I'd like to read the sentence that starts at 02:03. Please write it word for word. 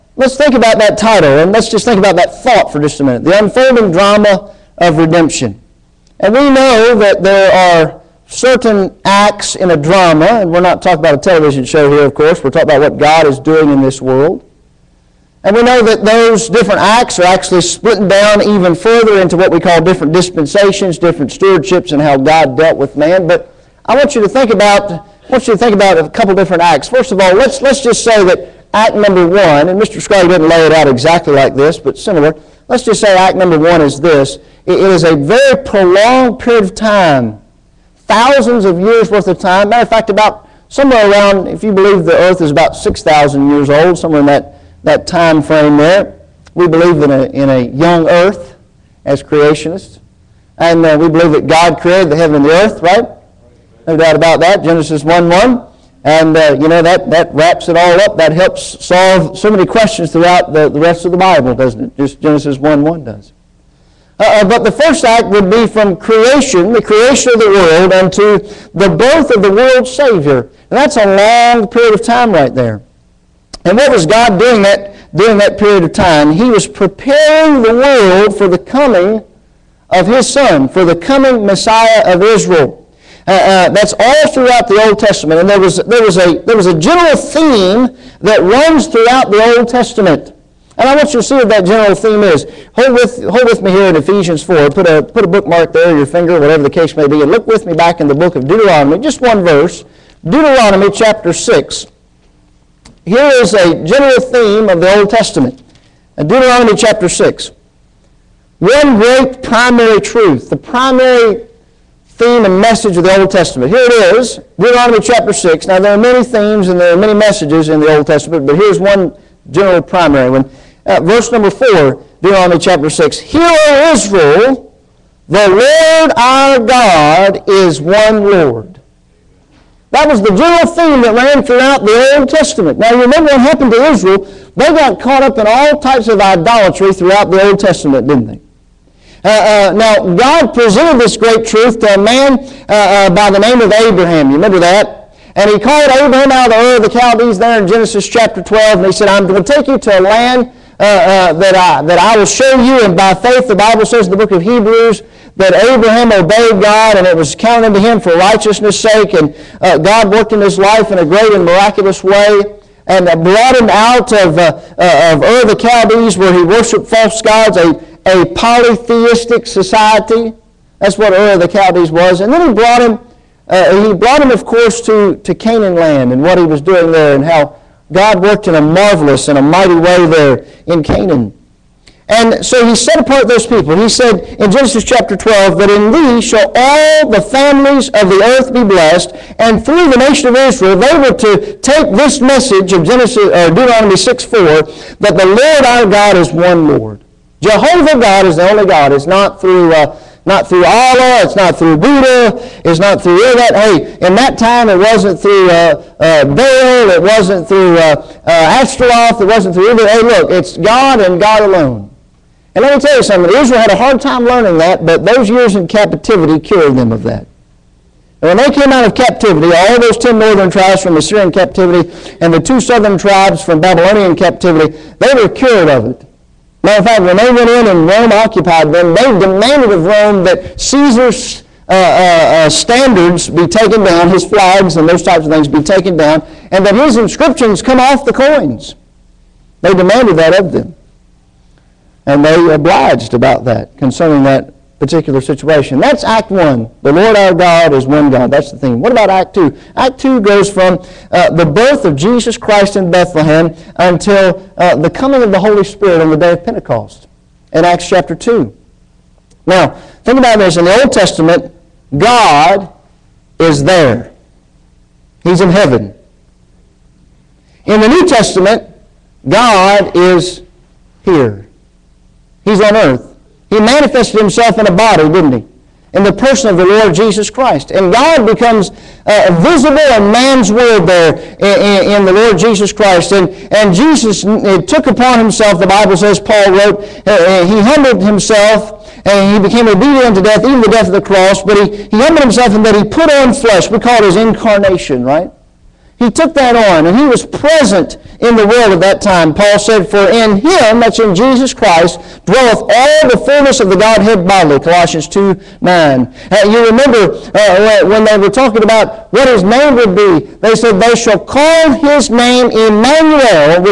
Hear, O Israel, the Lord our God is one Lord.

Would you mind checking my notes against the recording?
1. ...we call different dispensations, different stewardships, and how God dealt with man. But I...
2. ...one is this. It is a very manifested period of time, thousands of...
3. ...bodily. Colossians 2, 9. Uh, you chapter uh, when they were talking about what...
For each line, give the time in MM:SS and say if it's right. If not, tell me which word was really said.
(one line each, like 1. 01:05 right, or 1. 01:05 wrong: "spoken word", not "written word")
1. 00:19 right
2. 00:33 wrong: "prolonged", not "manifested"
3. 05:04 wrong: "remember", not "chapter".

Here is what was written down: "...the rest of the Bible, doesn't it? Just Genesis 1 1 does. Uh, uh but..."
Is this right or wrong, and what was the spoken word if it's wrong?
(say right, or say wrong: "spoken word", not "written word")
right.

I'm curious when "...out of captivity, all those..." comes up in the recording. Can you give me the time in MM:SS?
03:38.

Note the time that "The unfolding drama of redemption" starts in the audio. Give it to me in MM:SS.
00:03.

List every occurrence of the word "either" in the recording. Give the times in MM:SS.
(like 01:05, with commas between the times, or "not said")
03:29.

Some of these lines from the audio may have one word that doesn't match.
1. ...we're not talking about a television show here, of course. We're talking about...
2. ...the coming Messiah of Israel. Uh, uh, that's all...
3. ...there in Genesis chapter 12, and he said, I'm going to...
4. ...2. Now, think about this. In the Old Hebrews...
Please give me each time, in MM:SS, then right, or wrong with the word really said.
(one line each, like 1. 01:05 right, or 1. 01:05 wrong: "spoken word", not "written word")
1. 00:10 right
2. 01:20 right
3. 02:27 right
4. 04:18 wrong: "Testament", not "Hebrews".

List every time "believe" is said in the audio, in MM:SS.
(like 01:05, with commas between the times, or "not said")
00:41, 00:46, 00:51.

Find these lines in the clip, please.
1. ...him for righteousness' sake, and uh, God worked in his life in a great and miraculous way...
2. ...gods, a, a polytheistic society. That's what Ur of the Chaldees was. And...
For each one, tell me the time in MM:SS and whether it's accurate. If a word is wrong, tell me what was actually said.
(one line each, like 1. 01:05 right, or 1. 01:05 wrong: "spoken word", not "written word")
1. 02:37 right
2. 02:47 right.